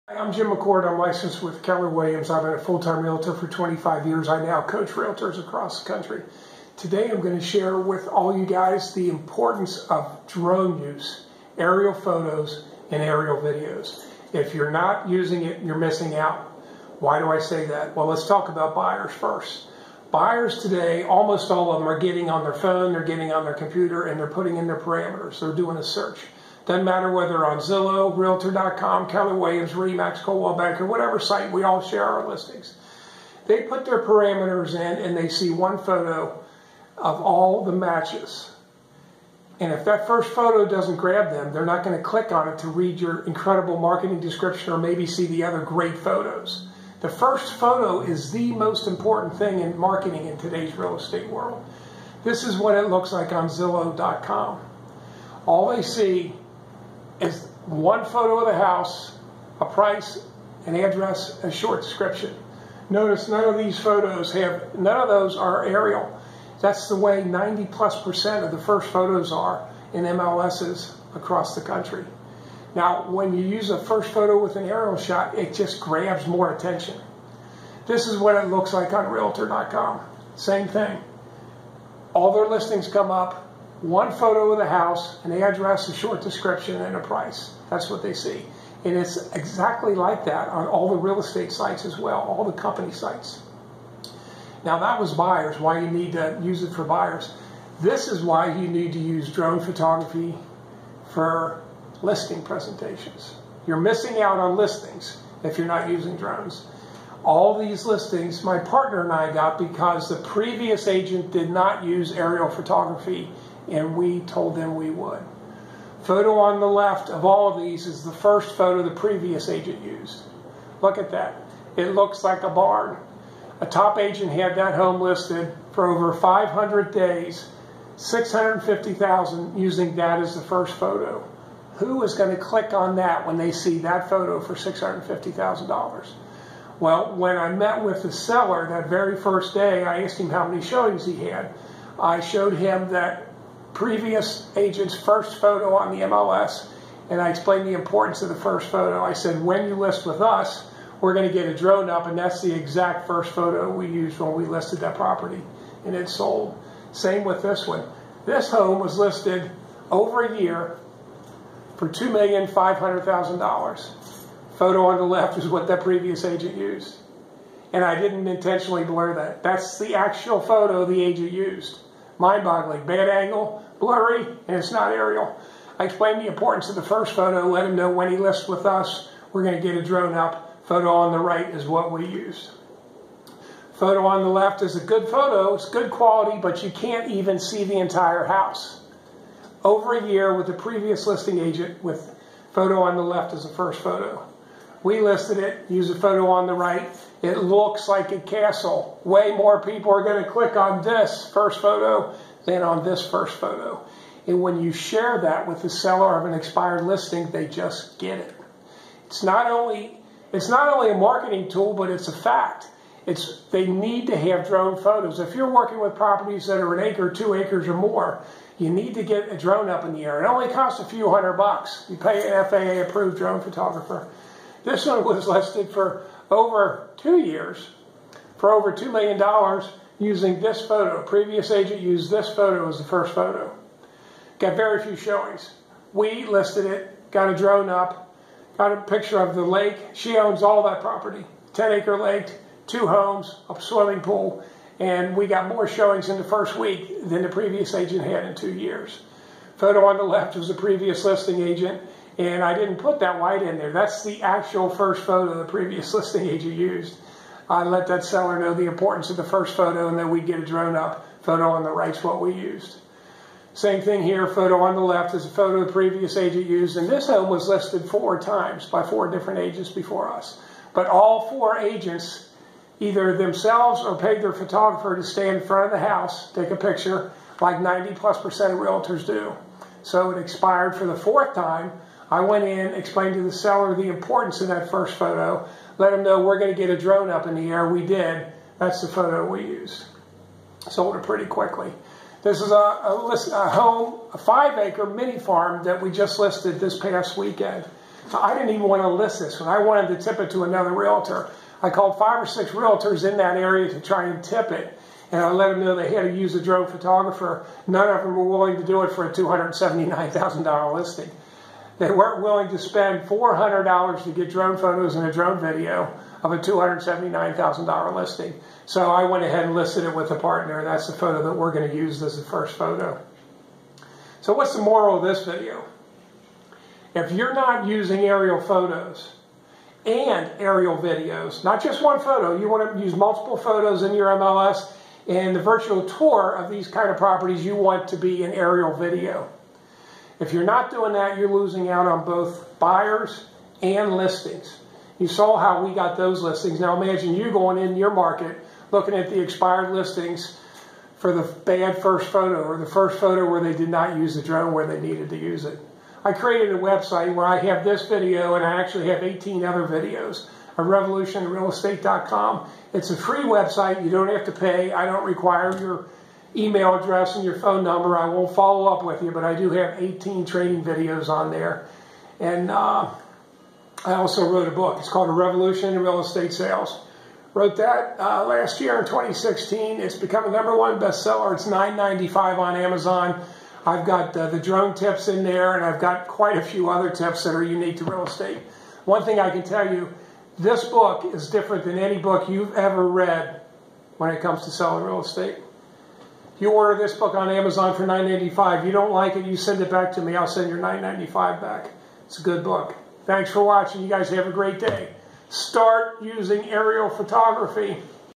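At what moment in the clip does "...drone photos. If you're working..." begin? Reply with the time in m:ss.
3:34.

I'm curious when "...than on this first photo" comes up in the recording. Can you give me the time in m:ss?
3:22.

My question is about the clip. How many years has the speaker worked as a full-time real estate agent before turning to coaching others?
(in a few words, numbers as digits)
25 years.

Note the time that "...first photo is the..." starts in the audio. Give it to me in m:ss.
0:47.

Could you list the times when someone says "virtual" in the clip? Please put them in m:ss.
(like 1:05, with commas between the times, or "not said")
5:35.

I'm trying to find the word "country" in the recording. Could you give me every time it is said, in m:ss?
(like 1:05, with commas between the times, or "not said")
0:05, 1:11.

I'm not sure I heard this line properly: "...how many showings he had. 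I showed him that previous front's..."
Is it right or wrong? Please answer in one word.
wrong.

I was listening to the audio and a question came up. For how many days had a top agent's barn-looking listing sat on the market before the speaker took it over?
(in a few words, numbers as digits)
over 500 days.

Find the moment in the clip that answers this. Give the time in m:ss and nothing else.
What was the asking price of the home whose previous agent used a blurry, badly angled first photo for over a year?
2:41.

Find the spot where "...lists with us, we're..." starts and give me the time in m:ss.
2:58.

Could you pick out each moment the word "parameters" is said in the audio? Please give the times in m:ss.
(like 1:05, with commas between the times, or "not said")
0:24, 0:34.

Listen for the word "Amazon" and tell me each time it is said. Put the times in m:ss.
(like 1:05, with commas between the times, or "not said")
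6:22, 6:37.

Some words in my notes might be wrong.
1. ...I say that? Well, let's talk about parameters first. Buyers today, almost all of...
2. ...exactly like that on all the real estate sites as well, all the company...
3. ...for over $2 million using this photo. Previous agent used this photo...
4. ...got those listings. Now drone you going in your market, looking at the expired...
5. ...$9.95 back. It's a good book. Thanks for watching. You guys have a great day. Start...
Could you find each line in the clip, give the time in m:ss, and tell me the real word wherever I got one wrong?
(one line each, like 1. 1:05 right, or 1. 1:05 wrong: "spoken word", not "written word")
1. 0:17 wrong: "buyers", not "parameters"
2. 1:29 right
3. 3:48 right
4. 5:45 wrong: "imagine", not "drone"
5. 6:40 right.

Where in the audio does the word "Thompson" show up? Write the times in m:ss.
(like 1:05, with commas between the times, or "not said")
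not said.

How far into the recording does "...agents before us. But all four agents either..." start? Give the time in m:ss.
4:29.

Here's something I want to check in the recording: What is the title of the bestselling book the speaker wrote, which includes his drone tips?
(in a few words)
A Revolution in Real Estate Sales.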